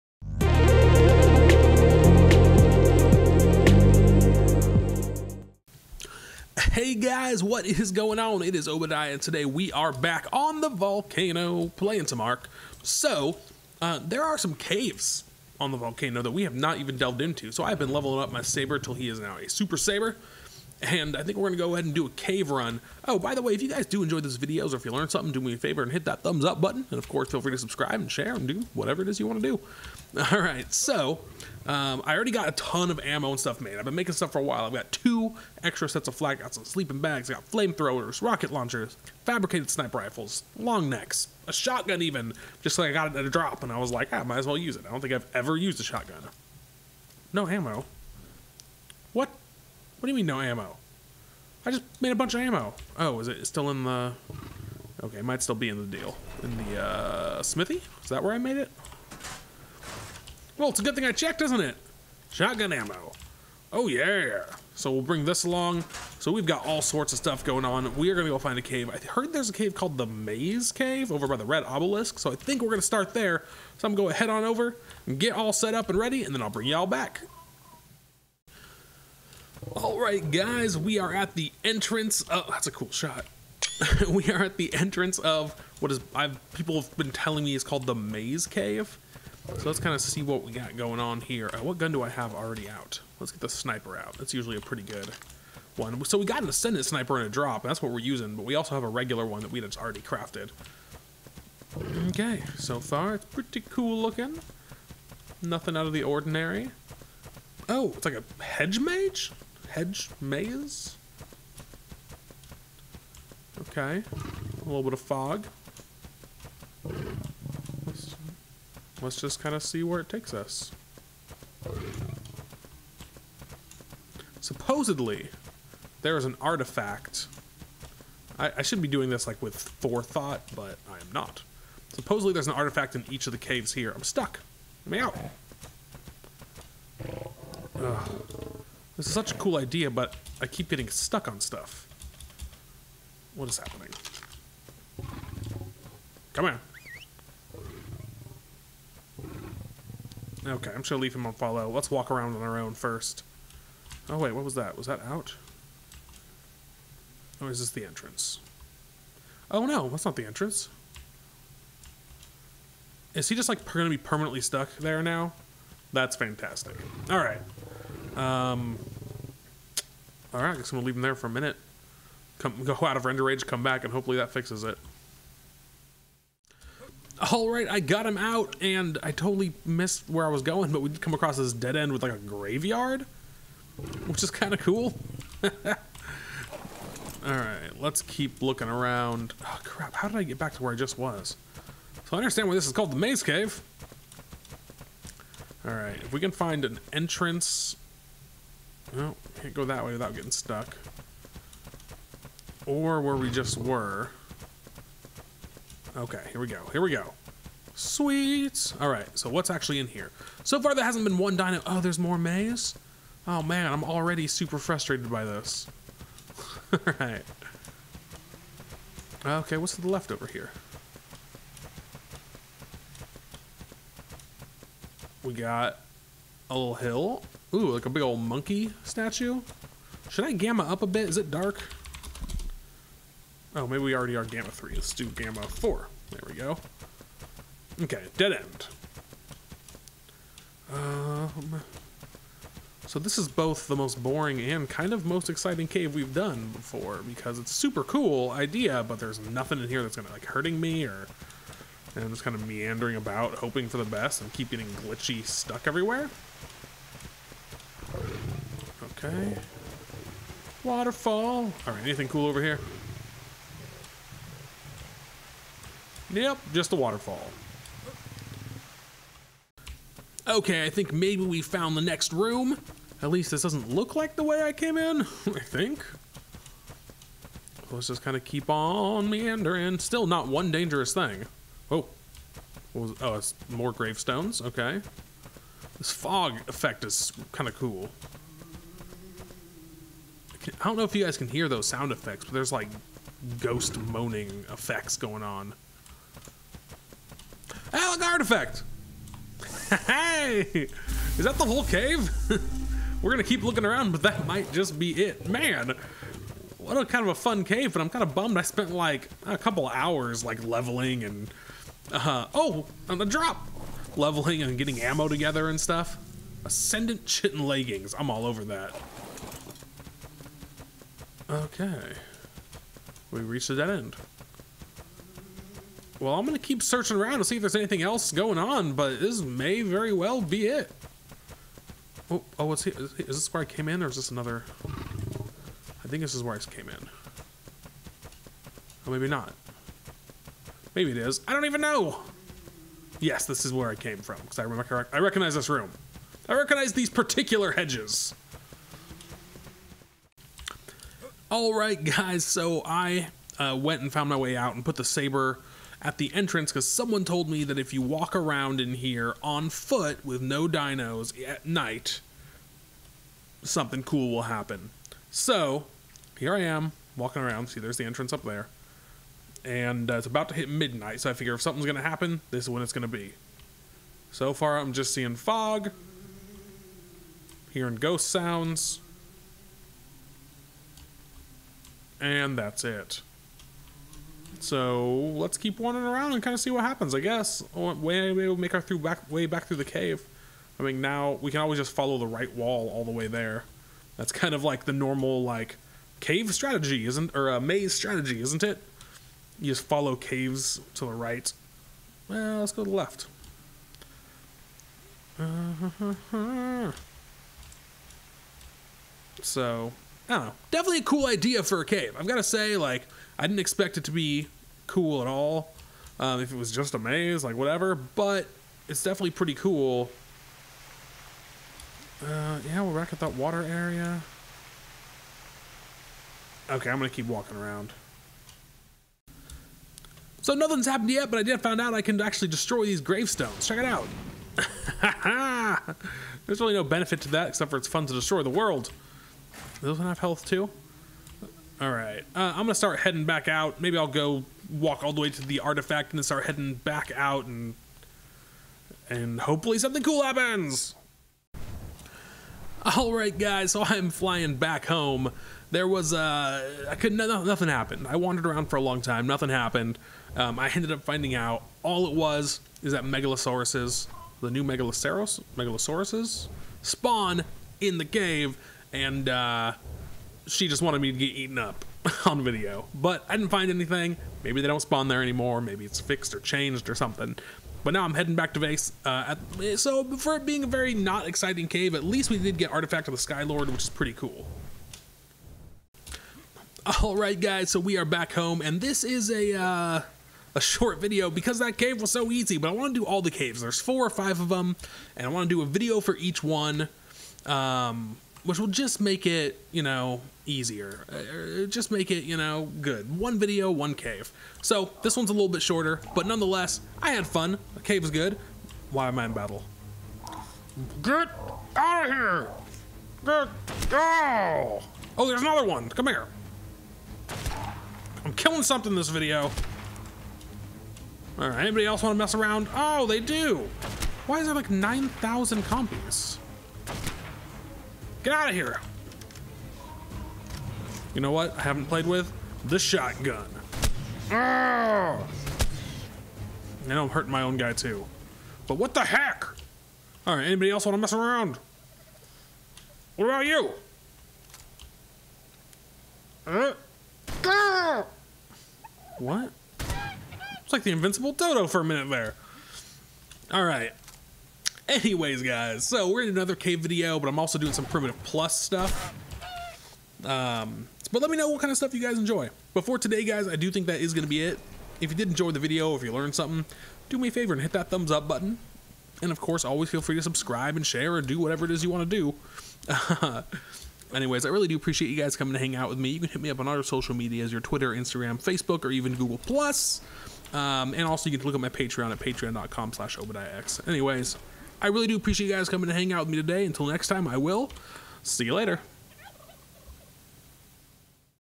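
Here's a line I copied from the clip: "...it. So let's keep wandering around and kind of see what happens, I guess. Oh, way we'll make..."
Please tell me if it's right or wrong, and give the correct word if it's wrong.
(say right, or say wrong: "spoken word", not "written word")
right.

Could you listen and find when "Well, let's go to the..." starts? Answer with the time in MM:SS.
06:42.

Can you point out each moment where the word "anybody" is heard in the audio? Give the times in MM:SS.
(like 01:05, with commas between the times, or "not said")
08:41, 09:00.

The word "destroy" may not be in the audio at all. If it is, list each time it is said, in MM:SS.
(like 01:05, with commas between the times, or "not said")
07:12, 07:17.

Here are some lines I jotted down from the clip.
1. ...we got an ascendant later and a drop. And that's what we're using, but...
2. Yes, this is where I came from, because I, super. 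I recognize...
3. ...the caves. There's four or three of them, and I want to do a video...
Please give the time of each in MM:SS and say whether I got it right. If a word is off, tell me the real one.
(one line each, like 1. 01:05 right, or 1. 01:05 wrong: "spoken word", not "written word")
1. 01:36 wrong: "sniper", not "later"
2. 05:42 wrong: "remember", not "super"
3. 08:13 wrong: "five", not "three".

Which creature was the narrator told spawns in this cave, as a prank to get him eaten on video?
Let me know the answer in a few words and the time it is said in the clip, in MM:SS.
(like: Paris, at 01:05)
Megalosaurus, at 07:44.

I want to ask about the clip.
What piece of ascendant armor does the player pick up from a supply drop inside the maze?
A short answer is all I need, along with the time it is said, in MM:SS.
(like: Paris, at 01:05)
Ascendant Chitin Leggings, at 05:16.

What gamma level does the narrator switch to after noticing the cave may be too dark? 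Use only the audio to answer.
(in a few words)
4.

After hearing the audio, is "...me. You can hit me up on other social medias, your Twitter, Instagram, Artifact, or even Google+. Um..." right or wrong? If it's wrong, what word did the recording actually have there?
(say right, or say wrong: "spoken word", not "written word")
wrong: "Facebook", not "Artifact".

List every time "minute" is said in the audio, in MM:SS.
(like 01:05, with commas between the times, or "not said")
02:51, 09:11.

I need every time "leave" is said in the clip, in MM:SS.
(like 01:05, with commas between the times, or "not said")
02:31, 02:50.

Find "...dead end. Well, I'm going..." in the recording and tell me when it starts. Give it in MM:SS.
05:23.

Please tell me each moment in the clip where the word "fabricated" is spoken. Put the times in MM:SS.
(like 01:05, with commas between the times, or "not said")
00:39.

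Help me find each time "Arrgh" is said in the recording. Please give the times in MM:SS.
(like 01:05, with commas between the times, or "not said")
08:54.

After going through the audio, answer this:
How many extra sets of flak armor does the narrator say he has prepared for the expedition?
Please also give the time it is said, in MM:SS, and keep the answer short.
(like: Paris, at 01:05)
2, at 00:34.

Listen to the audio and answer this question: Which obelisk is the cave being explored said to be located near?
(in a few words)
Red Obelisk.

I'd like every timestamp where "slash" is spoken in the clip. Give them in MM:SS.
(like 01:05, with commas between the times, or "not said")
09:42.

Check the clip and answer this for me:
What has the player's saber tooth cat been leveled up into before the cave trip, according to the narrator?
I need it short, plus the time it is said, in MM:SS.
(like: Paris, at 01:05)
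super saber, at 00:19.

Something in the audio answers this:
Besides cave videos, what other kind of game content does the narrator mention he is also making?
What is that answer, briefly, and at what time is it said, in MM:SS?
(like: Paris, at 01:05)
Primitive Plus, at 09:17.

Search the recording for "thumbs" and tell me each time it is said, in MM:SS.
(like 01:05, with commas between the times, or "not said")
00:26, 09:27.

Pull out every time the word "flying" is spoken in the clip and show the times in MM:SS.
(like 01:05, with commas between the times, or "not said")
07:33.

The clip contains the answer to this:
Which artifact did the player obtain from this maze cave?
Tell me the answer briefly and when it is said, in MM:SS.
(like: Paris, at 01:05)
Artifact of the Skylord, at 08:02.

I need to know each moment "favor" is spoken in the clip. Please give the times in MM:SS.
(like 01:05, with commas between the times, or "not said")
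00:25, 09:27.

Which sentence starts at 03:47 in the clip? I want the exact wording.
Ooh, like a big old monkey statue.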